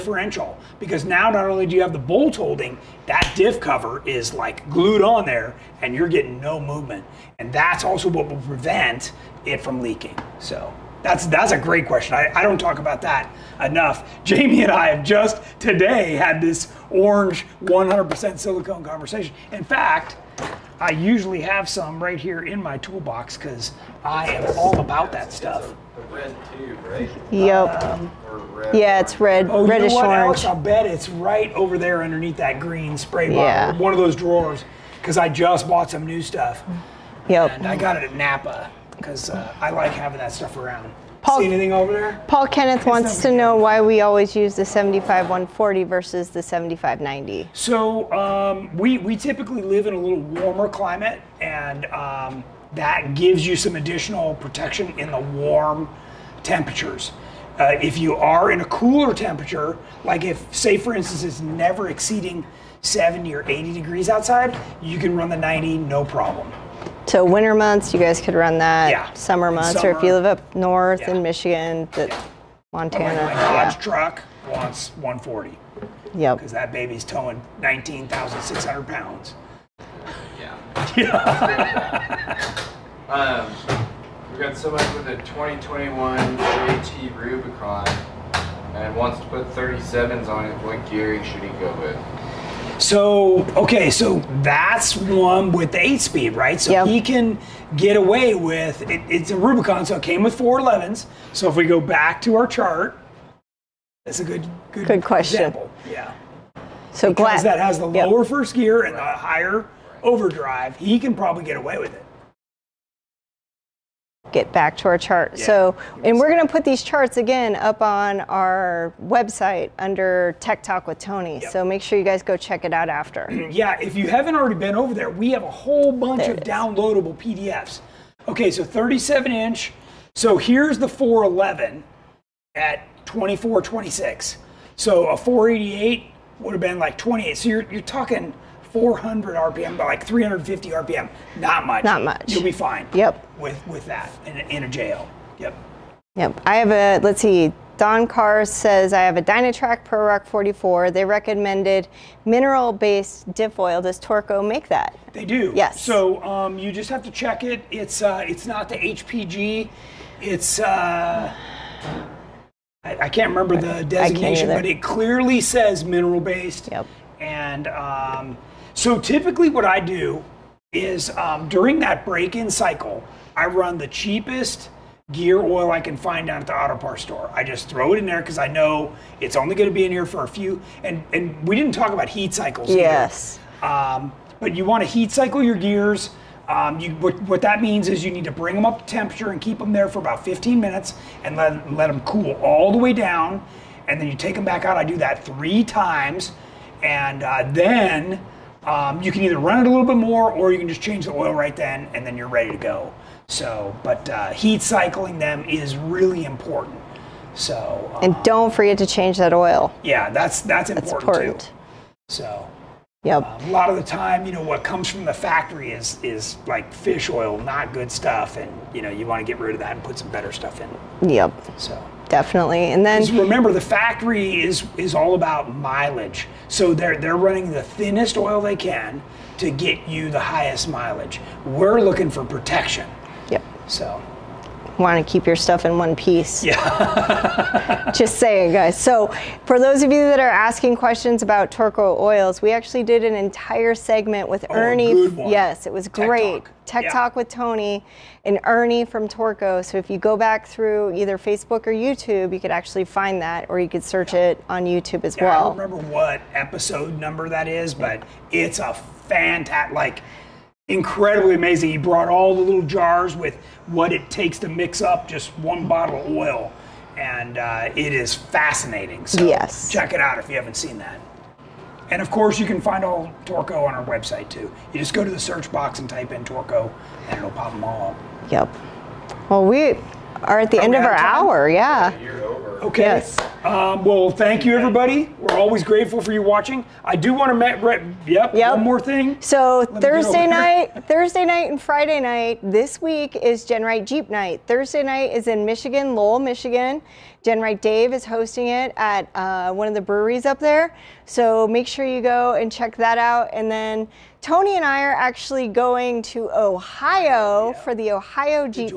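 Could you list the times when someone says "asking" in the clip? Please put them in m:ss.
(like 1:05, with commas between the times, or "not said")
4:00.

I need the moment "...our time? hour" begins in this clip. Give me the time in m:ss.
4:40.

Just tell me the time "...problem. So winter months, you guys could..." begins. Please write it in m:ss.
1:06.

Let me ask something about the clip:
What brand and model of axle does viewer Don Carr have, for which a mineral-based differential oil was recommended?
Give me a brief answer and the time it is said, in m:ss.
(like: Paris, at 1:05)
Dynatrac ProRock 44, at 2:29.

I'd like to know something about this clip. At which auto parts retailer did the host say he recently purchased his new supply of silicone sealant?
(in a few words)
Napa.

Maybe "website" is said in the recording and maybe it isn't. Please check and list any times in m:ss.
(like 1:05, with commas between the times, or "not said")
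1:59, 4:33.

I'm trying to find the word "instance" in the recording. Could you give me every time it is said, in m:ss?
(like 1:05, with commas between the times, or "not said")
1:00.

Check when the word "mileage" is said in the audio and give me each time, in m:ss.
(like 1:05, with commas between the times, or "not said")
3:45, 3:50.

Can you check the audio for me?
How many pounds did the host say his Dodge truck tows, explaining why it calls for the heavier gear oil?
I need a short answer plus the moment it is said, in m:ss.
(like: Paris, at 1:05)
19,600, at 1:17.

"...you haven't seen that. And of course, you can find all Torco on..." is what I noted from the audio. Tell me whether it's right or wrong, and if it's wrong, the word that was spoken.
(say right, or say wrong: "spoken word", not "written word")
right.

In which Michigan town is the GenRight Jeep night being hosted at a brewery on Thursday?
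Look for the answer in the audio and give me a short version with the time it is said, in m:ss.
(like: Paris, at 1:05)
Lowell, at 4:55.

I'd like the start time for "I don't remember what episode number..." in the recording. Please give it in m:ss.
4:15.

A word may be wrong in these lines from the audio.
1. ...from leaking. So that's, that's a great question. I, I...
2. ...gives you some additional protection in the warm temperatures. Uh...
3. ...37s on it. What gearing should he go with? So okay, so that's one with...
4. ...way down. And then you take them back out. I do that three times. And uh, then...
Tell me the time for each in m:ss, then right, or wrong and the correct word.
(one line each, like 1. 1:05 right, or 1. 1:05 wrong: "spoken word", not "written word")
1. 0:09 right
2. 0:53 right
3. 1:29 right
4. 3:12 right.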